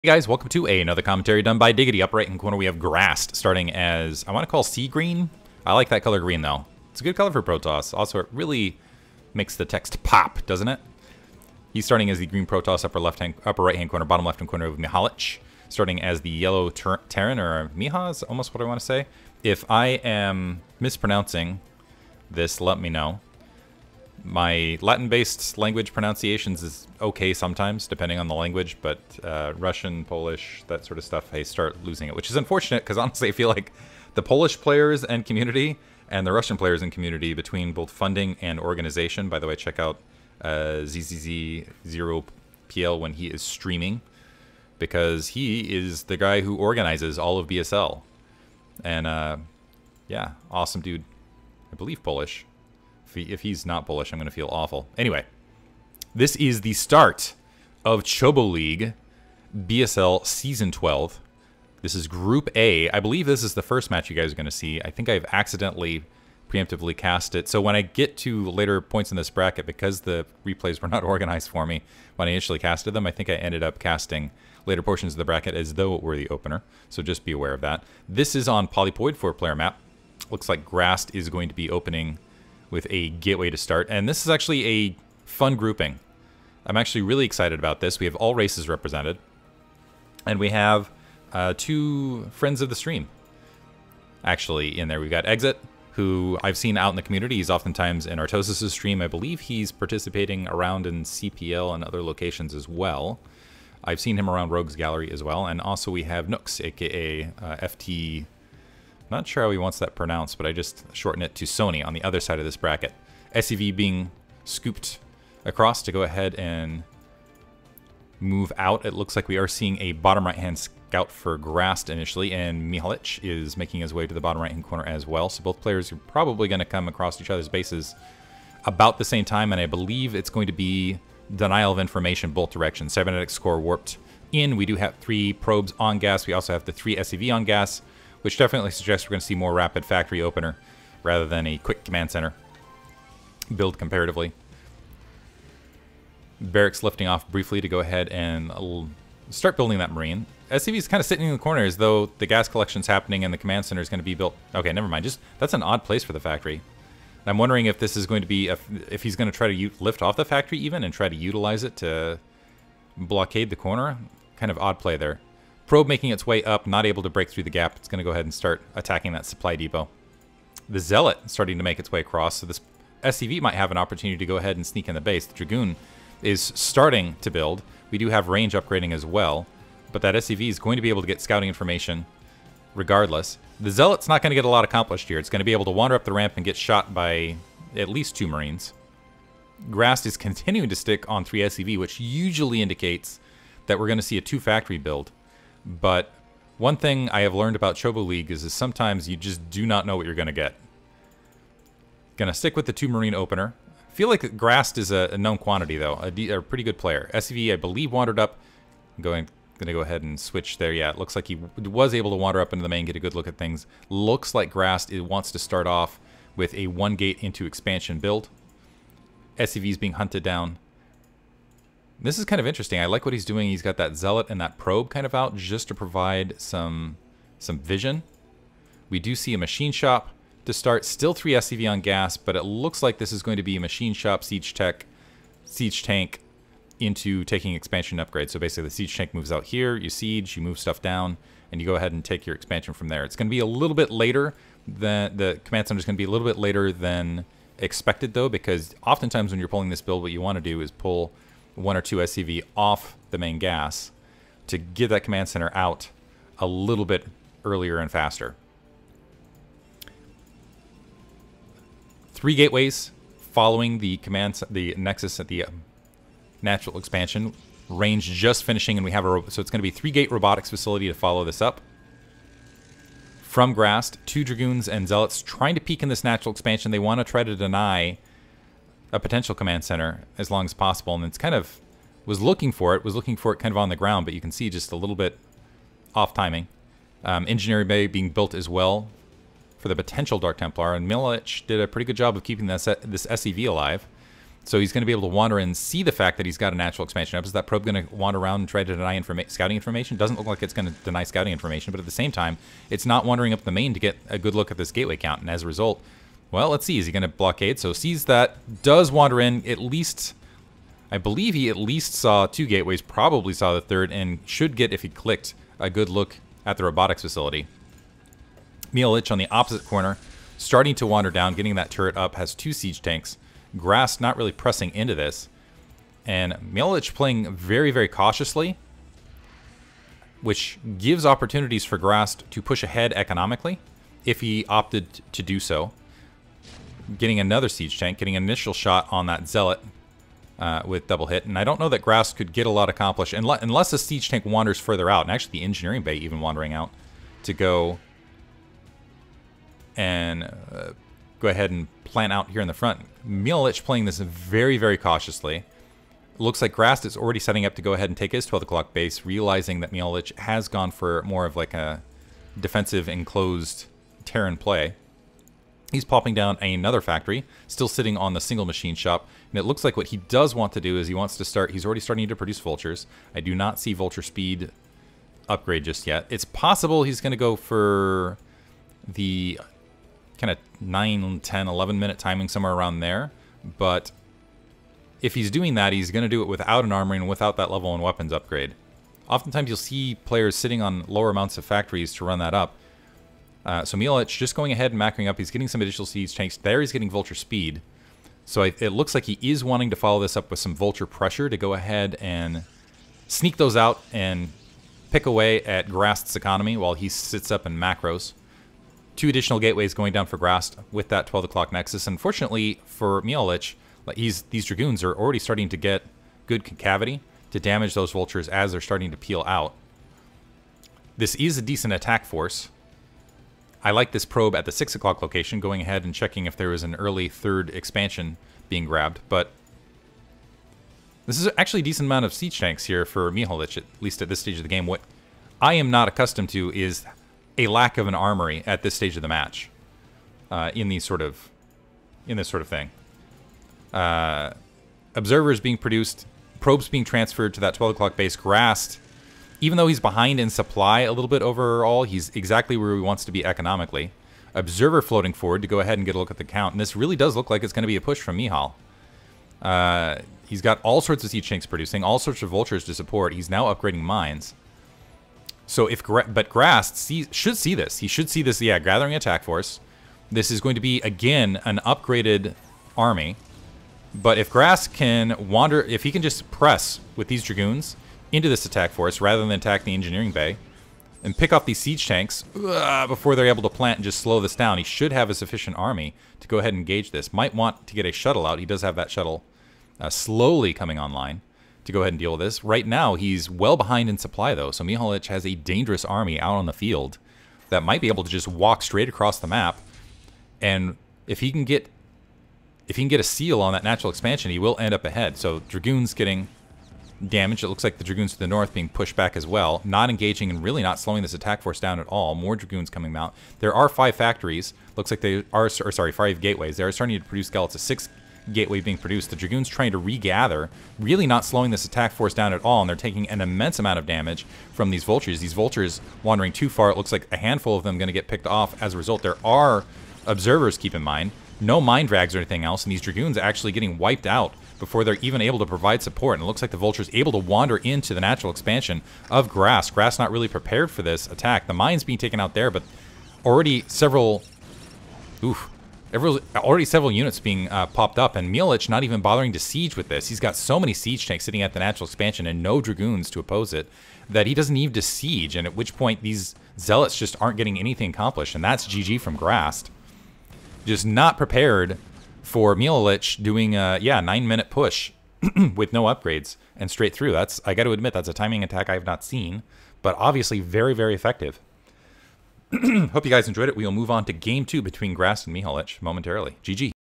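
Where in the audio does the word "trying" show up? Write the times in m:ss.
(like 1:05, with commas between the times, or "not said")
4:35, 8:39.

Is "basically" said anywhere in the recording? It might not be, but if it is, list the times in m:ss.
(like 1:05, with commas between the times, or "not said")
3:58.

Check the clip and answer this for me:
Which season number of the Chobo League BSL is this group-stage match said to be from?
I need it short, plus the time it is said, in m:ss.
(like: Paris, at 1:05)
12, at 1:00.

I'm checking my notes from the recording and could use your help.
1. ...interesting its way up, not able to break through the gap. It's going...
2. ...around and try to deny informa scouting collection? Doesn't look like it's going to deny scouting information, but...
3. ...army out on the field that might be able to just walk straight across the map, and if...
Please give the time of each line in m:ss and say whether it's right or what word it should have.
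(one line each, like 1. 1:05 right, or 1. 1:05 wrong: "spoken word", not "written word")
1. 2:45 wrong: "making", not "interesting"
2. 4:58 wrong: "information", not "collection"
3. 8:15 right.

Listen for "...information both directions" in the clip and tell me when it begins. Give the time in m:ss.
2:11.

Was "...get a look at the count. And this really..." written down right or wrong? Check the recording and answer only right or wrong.
right.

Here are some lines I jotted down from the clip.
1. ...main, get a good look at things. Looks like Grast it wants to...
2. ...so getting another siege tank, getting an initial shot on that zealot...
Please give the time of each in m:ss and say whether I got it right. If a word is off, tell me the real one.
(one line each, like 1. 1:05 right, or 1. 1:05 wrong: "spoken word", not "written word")
1. 3:32 right
2. 5:35 right.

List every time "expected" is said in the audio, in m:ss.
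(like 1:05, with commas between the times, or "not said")
4:07.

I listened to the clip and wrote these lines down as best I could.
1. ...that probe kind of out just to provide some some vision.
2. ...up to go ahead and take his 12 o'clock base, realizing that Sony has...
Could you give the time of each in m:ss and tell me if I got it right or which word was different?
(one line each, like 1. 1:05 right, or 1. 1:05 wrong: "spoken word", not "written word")
1. 3:44 right
2. 5:57 wrong: "Milich", not "Sony".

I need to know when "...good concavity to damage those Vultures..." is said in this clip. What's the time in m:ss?
6:56.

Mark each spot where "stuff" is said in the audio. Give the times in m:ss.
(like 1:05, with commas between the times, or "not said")
0:31, 4:00.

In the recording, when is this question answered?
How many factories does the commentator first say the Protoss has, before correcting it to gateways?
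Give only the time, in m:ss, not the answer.
8:33.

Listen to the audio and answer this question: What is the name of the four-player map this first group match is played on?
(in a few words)
Polypoid.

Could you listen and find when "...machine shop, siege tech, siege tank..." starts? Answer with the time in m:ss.
3:53.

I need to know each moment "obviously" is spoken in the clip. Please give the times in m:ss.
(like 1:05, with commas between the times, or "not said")
9:29.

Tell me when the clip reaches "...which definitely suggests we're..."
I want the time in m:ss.
2:18.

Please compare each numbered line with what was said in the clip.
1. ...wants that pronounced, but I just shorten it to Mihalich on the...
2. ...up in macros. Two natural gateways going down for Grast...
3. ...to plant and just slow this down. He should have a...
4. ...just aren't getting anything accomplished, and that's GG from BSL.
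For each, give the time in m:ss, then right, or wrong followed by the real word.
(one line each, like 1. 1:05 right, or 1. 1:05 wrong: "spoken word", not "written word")
1. 1:49 wrong: "Sony", not "Mihalich"
2. 6:47 wrong: "additional", not "natural"
3. 8:03 right
4. 9:16 wrong: "Grast", not "BSL".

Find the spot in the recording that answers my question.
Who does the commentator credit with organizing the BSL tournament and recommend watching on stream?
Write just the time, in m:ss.
0:40.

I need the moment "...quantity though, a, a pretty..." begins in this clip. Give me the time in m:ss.
3:25.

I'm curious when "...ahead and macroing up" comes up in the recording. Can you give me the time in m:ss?
6:34.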